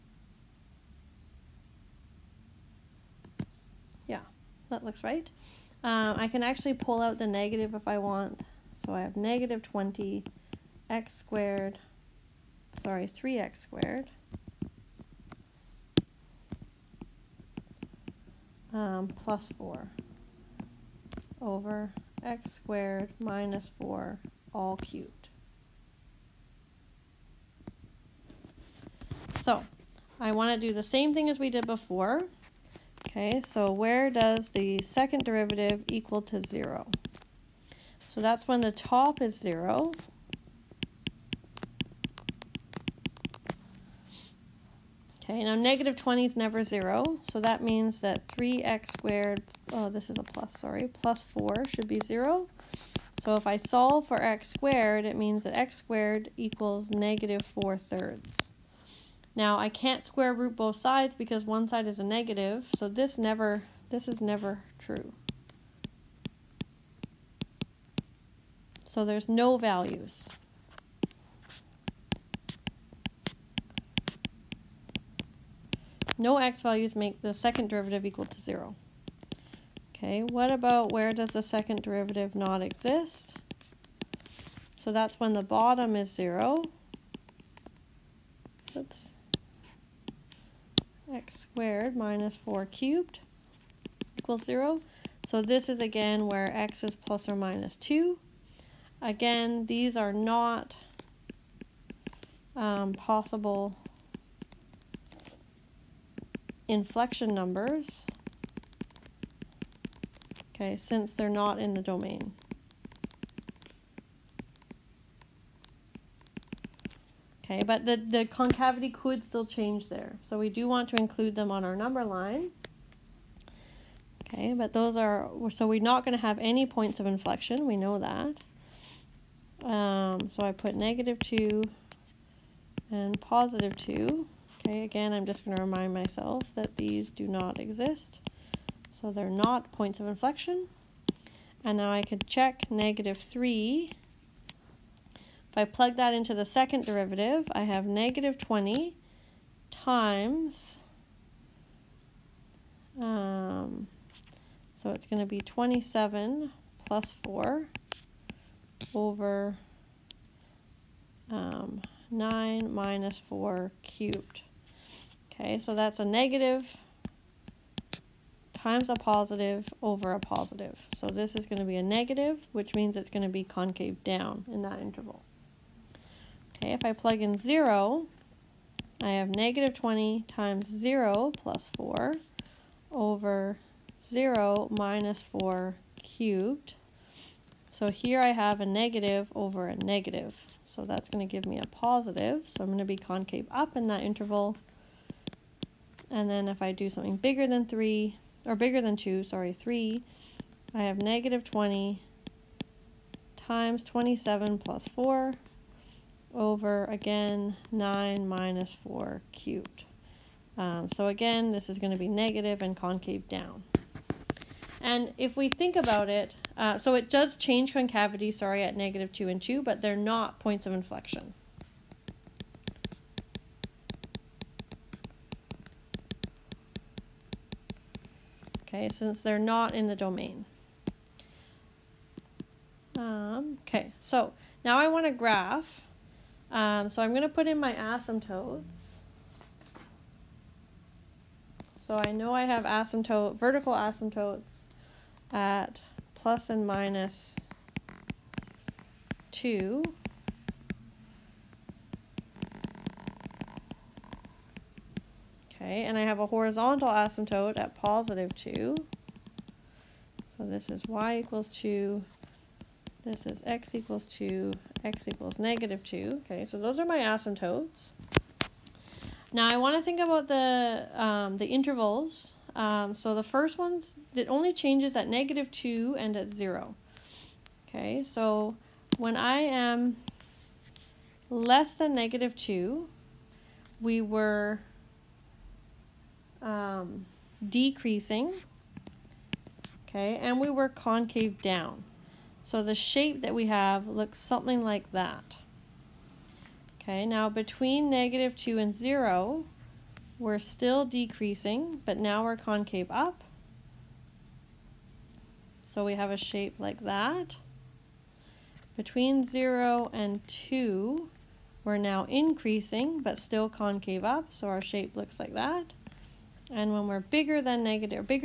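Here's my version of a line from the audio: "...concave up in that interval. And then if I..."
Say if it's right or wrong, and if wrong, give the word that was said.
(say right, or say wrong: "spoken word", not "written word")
right.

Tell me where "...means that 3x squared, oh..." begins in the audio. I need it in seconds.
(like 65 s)
47 s.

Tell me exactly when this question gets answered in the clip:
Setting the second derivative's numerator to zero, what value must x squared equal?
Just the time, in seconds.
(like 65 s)
56 s.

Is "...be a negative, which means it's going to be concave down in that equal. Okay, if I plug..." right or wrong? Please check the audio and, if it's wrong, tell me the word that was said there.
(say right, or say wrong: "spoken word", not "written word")
wrong: "interval", not "equal".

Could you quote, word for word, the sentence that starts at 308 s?
Between 0 and 2, we're now increasing, but still concave up, so our shape looks like that.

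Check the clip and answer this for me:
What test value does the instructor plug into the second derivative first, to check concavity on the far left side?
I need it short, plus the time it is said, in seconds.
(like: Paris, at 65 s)
-3, at 142 s.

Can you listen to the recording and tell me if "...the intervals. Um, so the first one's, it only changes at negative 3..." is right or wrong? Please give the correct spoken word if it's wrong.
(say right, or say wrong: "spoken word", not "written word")
wrong: "2", not "3".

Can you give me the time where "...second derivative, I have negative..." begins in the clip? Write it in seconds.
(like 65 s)
146 s.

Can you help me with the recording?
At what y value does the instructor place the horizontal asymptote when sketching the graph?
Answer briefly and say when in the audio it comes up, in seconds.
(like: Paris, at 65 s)
2, at 260 s.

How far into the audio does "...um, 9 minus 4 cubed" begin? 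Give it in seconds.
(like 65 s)
161 s.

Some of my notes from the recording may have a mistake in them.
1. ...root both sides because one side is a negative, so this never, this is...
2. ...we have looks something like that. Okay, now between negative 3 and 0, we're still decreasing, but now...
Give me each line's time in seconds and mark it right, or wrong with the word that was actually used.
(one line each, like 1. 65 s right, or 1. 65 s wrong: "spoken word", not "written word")
1. 60 s right
2. 293 s wrong: "2", not "3".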